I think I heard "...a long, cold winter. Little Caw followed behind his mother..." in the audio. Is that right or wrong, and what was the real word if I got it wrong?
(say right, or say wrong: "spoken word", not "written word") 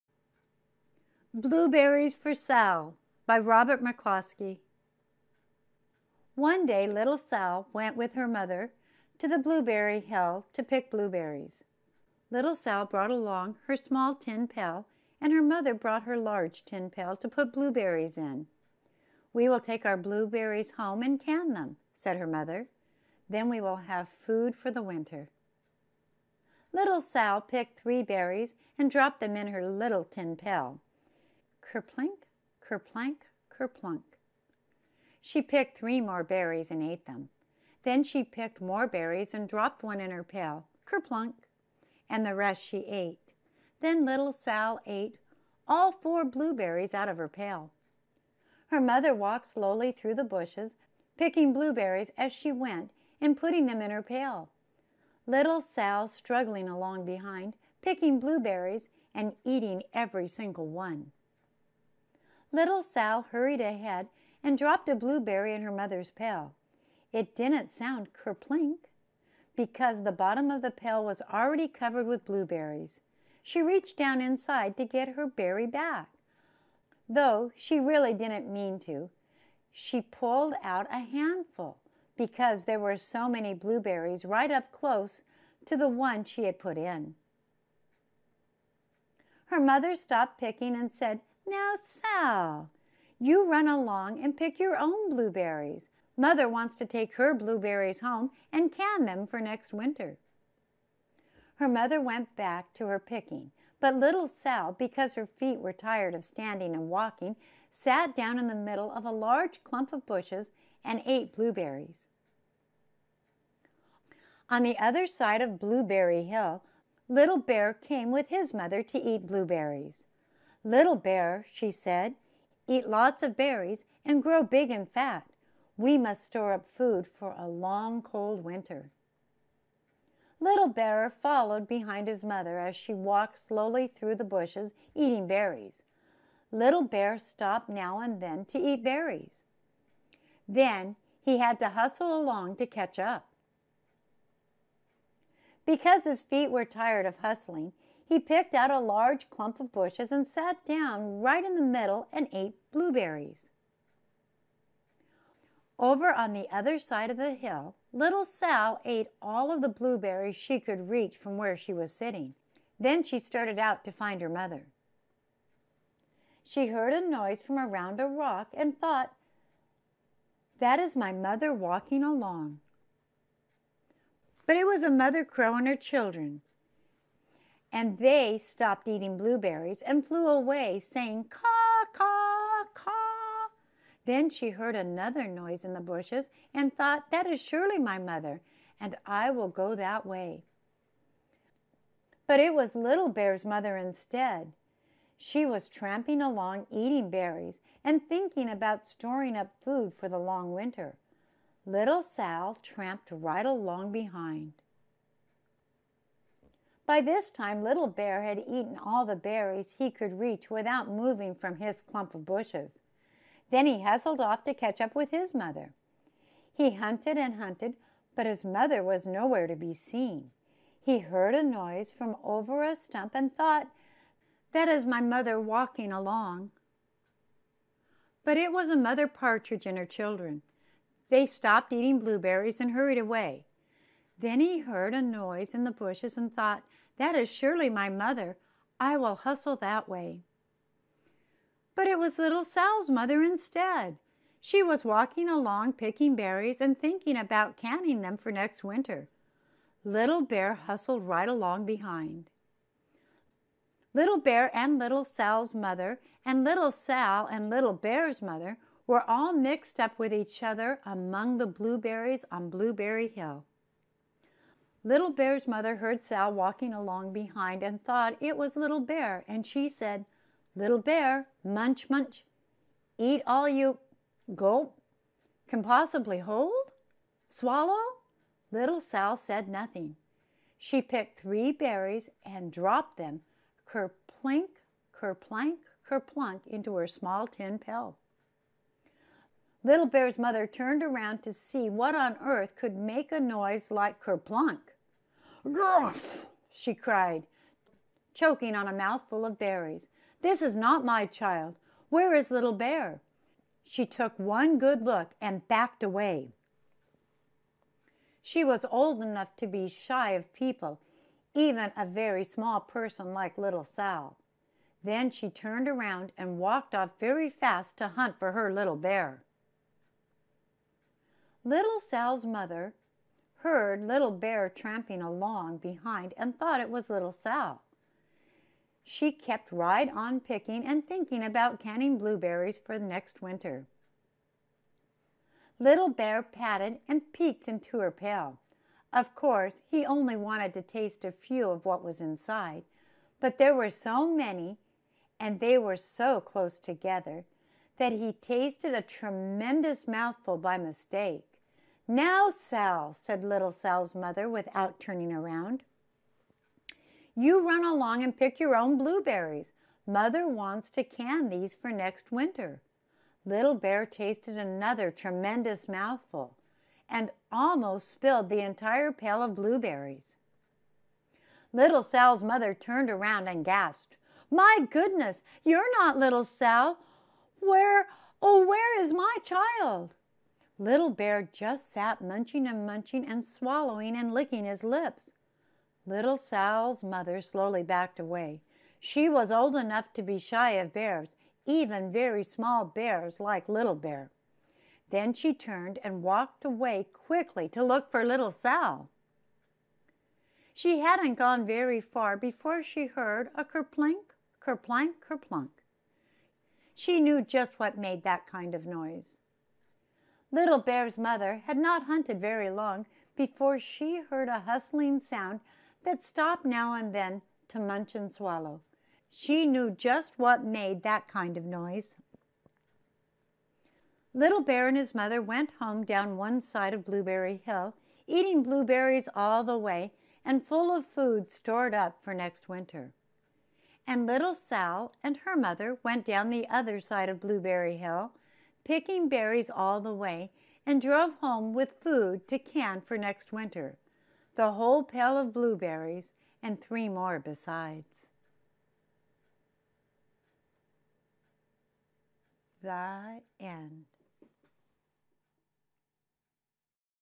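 wrong: "Bear", not "Caw".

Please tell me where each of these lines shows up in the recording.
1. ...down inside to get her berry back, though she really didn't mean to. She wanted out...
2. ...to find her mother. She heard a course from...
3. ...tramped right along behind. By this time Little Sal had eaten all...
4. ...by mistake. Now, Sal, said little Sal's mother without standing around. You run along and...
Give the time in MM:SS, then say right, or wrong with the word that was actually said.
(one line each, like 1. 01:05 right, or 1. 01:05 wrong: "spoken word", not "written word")
1. 01:13 wrong: "pulled", not "wanted"
2. 02:43 wrong: "noise", not "course"
3. 03:22 wrong: "Bear", not "Sal"
4. 05:50 wrong: "turning", not "standing".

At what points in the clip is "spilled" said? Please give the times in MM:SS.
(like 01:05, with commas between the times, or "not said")
06:07.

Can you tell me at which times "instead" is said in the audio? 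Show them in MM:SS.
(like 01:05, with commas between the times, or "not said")
03:13, 04:03.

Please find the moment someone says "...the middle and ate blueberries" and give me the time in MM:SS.
02:31.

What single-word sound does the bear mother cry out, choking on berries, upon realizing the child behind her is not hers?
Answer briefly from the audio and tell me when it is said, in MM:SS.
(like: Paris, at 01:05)
Gruff, at 04:55.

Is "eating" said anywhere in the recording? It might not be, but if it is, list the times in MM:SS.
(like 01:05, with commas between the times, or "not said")
00:59, 02:14, 02:58, 03:16, 03:51, 07:08.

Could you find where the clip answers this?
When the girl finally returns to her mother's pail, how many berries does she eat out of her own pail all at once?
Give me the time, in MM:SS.
00:45.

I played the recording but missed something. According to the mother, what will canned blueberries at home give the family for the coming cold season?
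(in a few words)
food for the winter.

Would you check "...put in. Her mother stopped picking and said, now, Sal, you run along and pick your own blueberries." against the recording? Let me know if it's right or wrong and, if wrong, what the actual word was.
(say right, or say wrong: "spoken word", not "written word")
right.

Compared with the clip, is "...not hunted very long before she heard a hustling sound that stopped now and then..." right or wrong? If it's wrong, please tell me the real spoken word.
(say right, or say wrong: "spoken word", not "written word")
right.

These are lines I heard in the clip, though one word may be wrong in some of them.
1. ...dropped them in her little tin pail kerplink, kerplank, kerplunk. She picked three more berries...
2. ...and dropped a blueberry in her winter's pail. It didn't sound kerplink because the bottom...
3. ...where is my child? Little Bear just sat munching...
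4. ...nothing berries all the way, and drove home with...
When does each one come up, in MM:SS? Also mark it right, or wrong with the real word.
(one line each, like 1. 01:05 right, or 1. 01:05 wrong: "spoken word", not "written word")
1. 00:28 right
2. 01:04 wrong: "mother", not "winter"
3. 06:18 right
4. 07:18 wrong: "picking", not "nothing".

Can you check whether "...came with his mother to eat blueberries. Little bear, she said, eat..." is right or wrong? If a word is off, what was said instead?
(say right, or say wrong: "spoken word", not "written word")
right.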